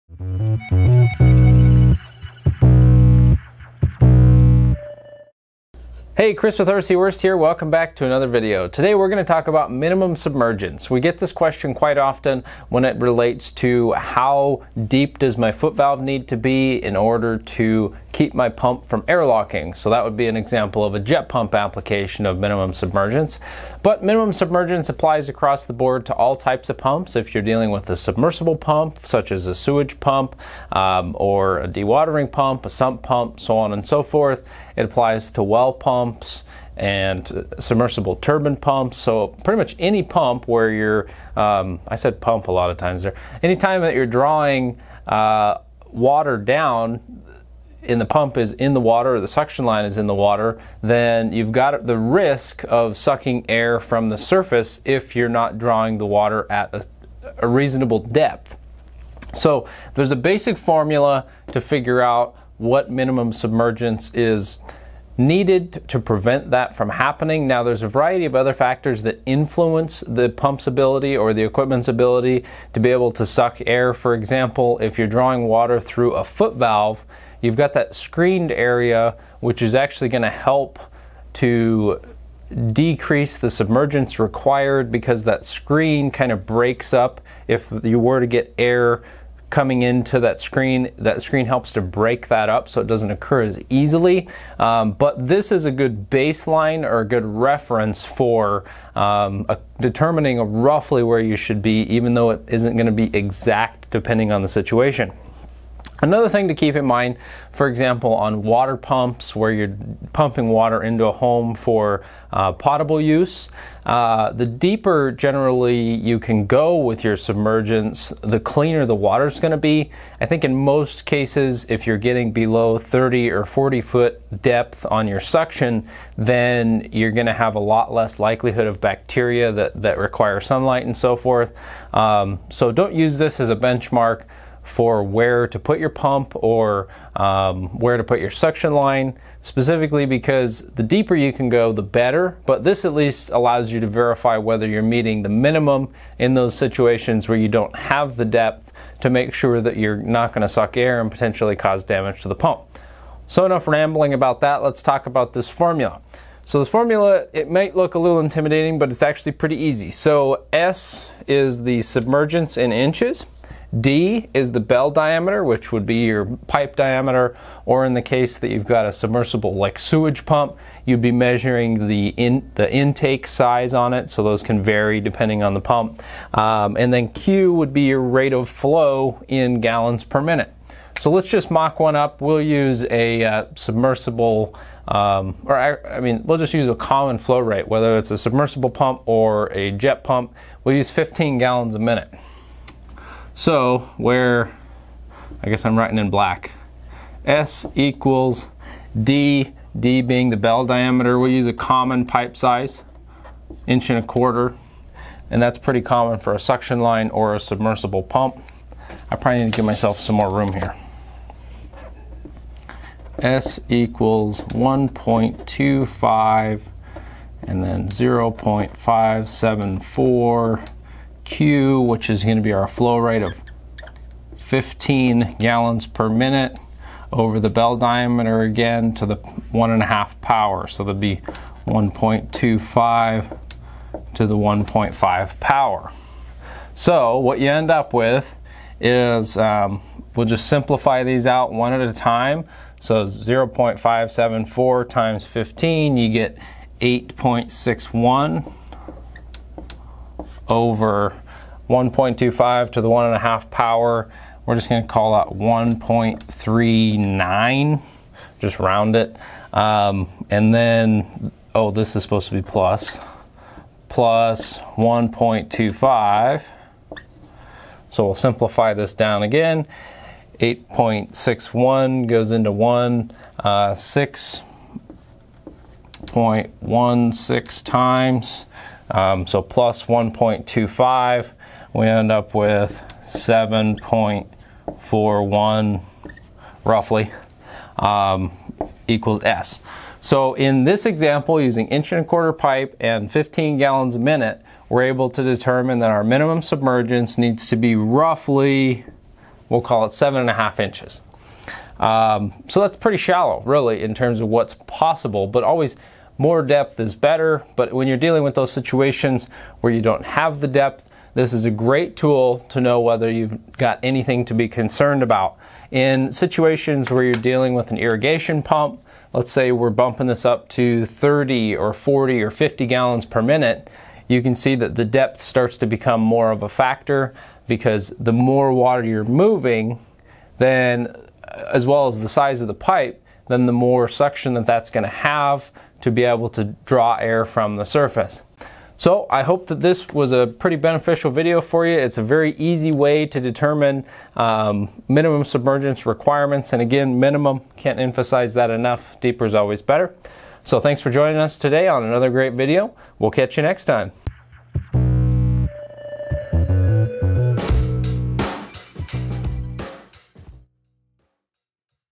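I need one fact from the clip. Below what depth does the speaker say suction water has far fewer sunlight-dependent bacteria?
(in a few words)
30 or 40 foot.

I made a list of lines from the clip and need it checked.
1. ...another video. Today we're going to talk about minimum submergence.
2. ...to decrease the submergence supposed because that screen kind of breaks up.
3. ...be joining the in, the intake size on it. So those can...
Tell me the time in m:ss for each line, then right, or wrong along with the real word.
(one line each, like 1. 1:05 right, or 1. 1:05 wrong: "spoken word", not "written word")
1. 0:08 right
2. 1:21 wrong: "required", not "supposed"
3. 2:51 wrong: "measuring", not "joining".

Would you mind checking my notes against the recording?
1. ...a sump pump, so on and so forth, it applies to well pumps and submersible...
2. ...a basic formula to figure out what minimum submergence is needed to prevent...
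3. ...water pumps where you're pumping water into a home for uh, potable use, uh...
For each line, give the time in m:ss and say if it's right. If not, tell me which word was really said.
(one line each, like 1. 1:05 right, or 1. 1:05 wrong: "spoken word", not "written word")
1. 0:32 right
2. 1:00 right
3. 1:48 right.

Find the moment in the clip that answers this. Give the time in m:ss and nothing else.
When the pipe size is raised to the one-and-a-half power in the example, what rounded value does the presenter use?
4:15.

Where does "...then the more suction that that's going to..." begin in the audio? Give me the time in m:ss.
5:33.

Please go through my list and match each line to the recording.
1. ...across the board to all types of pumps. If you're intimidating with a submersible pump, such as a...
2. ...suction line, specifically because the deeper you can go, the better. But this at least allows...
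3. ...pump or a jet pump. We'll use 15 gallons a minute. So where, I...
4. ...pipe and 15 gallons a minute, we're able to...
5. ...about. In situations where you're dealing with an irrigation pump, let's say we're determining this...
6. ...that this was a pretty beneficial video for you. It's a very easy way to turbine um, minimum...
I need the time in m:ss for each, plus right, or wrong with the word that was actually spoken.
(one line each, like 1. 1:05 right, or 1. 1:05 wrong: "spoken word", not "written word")
1. 0:25 wrong: "dealing", not "intimidating"
2. 2:18 right
3. 3:08 right
4. 4:52 right
5. 5:15 wrong: "bumping", not "determining"
6. 5:39 wrong: "determine", not "turbine".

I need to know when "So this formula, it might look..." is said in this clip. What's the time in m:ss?
2:36.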